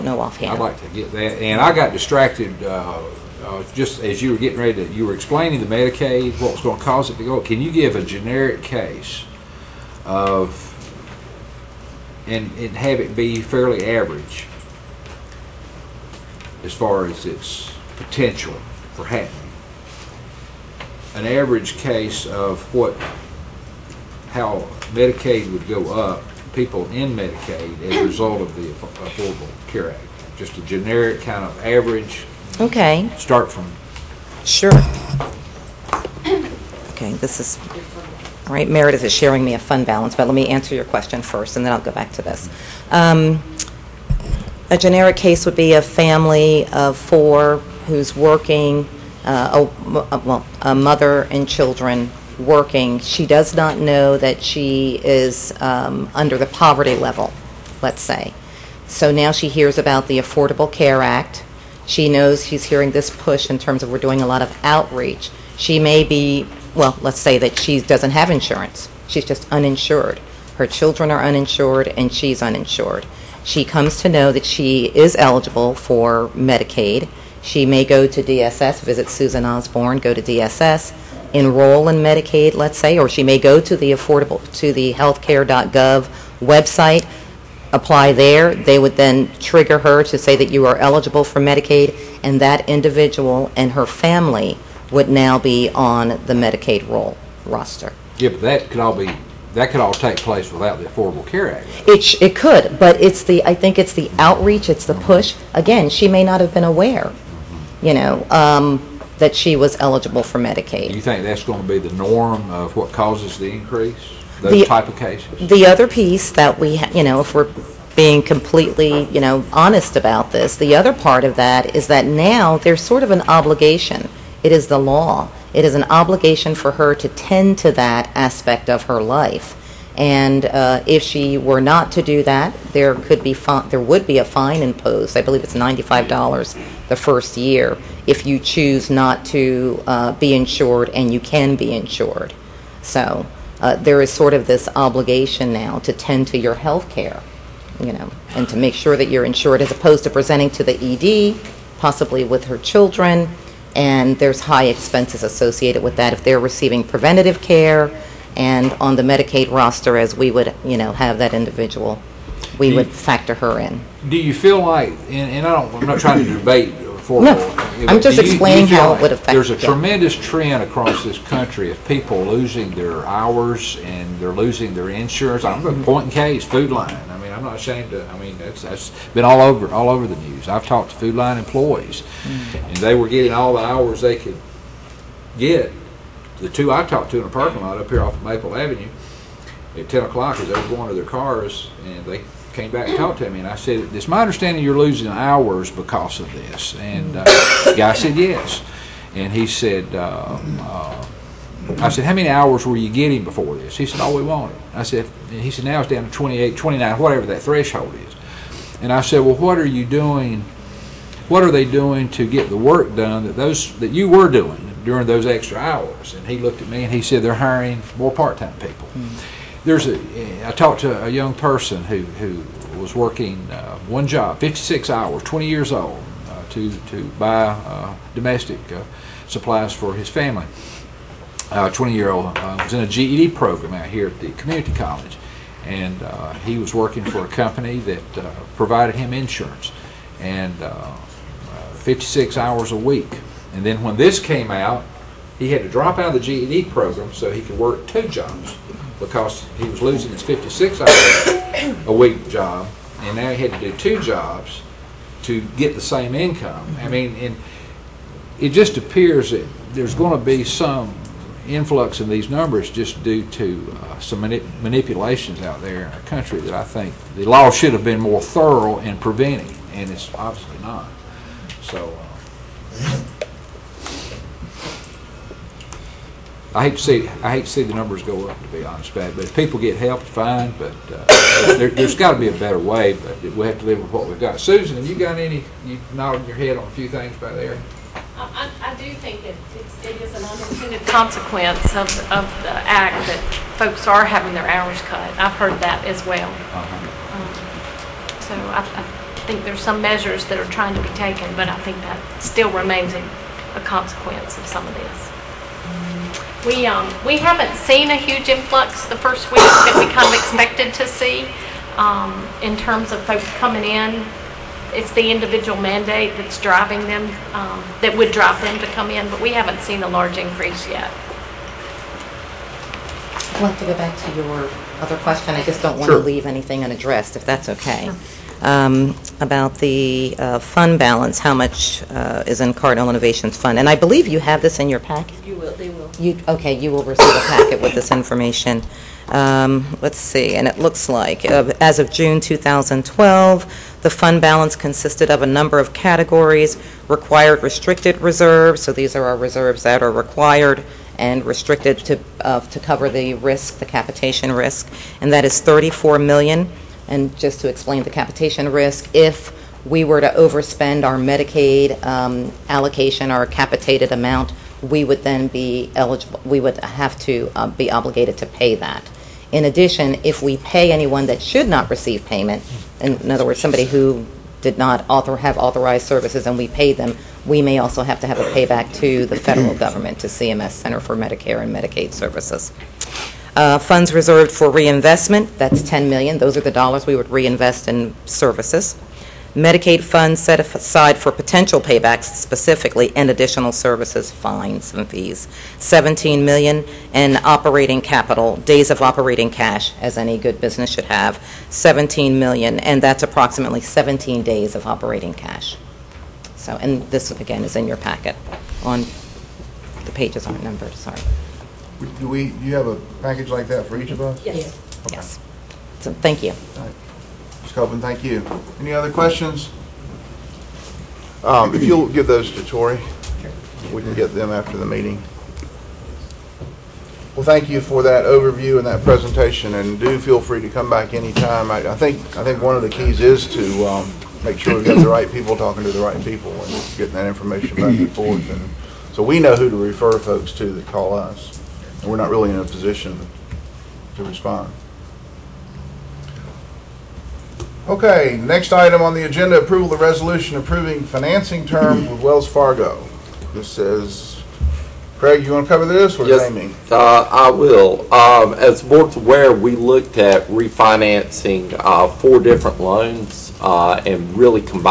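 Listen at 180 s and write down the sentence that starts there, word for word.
I've talked to Food Lion employees mm.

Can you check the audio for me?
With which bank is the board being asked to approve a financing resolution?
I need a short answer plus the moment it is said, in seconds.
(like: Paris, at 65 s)
Wells Fargo, at 452 s.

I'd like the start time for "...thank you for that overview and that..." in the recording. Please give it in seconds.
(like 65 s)
427 s.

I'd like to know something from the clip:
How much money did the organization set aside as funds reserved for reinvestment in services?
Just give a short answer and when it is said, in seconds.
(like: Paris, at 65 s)
$10 million, at 385 s.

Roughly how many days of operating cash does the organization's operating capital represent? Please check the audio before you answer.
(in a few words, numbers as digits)
17 days.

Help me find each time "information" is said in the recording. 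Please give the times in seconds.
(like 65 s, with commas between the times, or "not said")
337 s, 437 s.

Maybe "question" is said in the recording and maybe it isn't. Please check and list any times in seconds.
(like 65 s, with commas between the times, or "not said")
40 s, 324 s, 418 s.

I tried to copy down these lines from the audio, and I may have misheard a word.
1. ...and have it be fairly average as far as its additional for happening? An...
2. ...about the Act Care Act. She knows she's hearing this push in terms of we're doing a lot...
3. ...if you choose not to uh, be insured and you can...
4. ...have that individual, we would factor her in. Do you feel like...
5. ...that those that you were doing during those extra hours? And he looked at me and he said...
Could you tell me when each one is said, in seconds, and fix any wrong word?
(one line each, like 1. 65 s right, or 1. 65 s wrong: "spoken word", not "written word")
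1. 12 s wrong: "potential", not "additional"
2. 59 s wrong: "Affordable", not "Act"
3. 138 s right
4. 160 s right
5. 213 s right.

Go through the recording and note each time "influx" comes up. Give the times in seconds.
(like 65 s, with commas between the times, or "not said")
261 s, 308 s.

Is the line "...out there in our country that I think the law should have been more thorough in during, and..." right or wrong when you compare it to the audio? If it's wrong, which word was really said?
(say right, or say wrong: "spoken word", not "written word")
wrong: "preventing", not "during".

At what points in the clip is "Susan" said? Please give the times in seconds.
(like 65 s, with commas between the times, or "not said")
79 s, 284 s.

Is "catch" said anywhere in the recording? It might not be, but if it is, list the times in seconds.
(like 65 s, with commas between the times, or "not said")
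not said.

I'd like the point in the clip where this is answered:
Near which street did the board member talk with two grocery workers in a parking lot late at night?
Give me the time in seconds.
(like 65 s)
188 s.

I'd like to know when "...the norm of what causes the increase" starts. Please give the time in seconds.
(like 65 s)
111 s.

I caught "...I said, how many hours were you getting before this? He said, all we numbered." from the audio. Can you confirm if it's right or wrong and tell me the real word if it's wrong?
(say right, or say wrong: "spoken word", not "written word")
wrong: "wanted", not "numbered".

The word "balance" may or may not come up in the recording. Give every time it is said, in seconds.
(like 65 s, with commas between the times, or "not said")
39 s, 330 s, 344 s.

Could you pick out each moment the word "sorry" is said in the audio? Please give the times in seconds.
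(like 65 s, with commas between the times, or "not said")
410 s.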